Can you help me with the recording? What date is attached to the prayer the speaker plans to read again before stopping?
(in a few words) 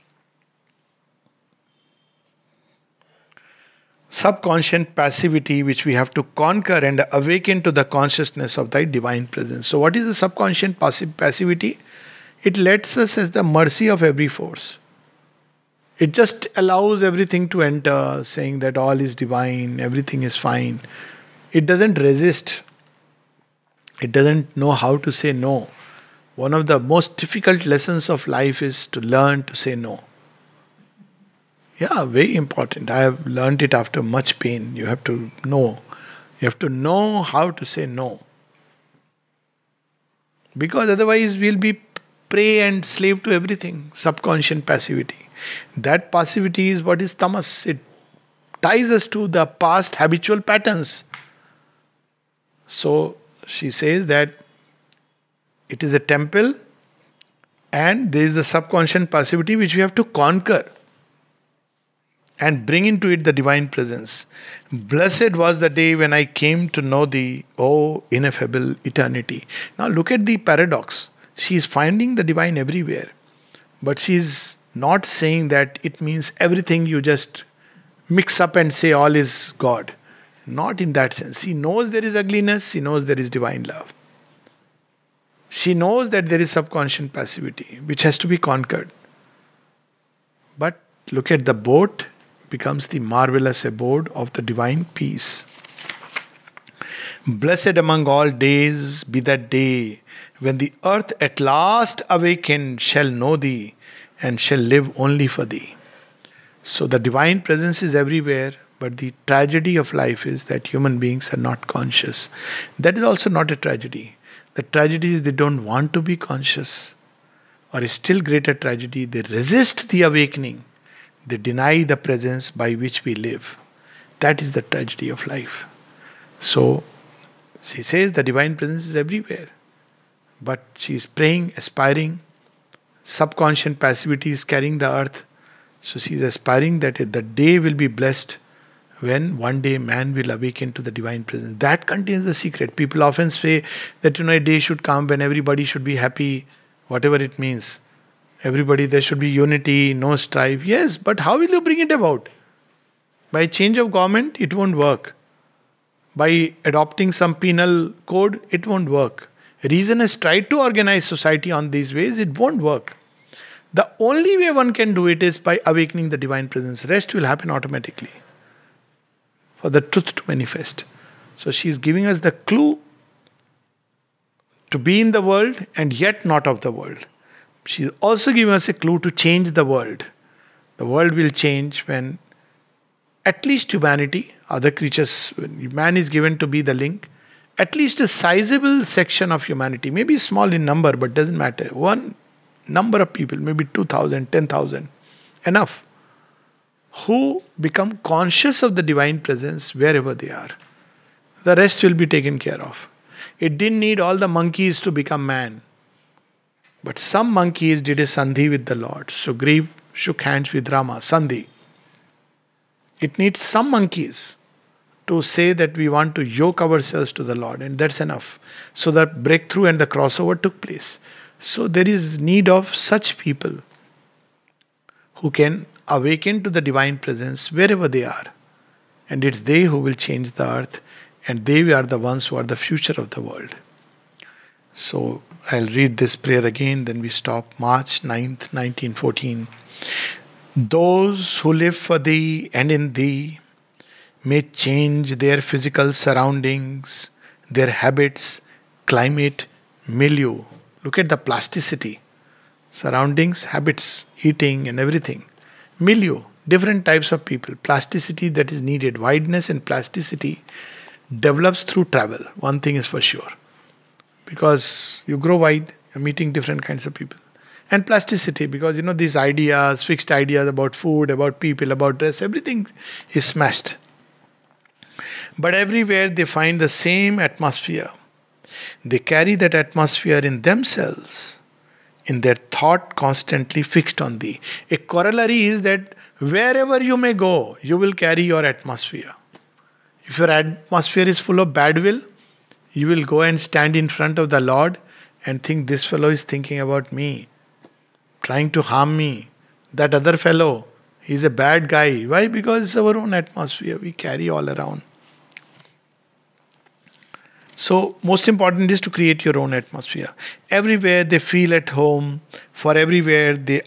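March 9th, 1914.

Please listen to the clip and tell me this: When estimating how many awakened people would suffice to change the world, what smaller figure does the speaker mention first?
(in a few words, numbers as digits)
2,000.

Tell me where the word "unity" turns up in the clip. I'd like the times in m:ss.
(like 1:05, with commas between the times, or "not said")
2:29.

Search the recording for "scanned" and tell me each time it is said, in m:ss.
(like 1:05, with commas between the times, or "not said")
not said.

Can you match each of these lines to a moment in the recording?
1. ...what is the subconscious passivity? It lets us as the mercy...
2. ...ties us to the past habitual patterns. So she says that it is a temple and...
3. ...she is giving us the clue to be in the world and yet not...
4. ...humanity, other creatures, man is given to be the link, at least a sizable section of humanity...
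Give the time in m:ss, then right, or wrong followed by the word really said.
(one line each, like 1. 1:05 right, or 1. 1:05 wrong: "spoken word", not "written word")
1. 0:09 right
2. 0:48 right
3. 2:51 right
4. 3:03 right.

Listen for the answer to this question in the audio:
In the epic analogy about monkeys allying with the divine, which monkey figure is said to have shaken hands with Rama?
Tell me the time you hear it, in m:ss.
3:29.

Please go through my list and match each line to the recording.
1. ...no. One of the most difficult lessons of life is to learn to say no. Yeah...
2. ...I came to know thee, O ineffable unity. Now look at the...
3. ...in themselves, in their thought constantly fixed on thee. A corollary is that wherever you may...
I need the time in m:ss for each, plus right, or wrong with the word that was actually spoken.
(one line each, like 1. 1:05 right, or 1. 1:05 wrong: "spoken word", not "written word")
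1. 0:25 right
2. 1:06 wrong: "eternity", not "unity"
3. 4:40 right.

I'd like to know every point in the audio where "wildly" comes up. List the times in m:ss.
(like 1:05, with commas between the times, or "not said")
not said.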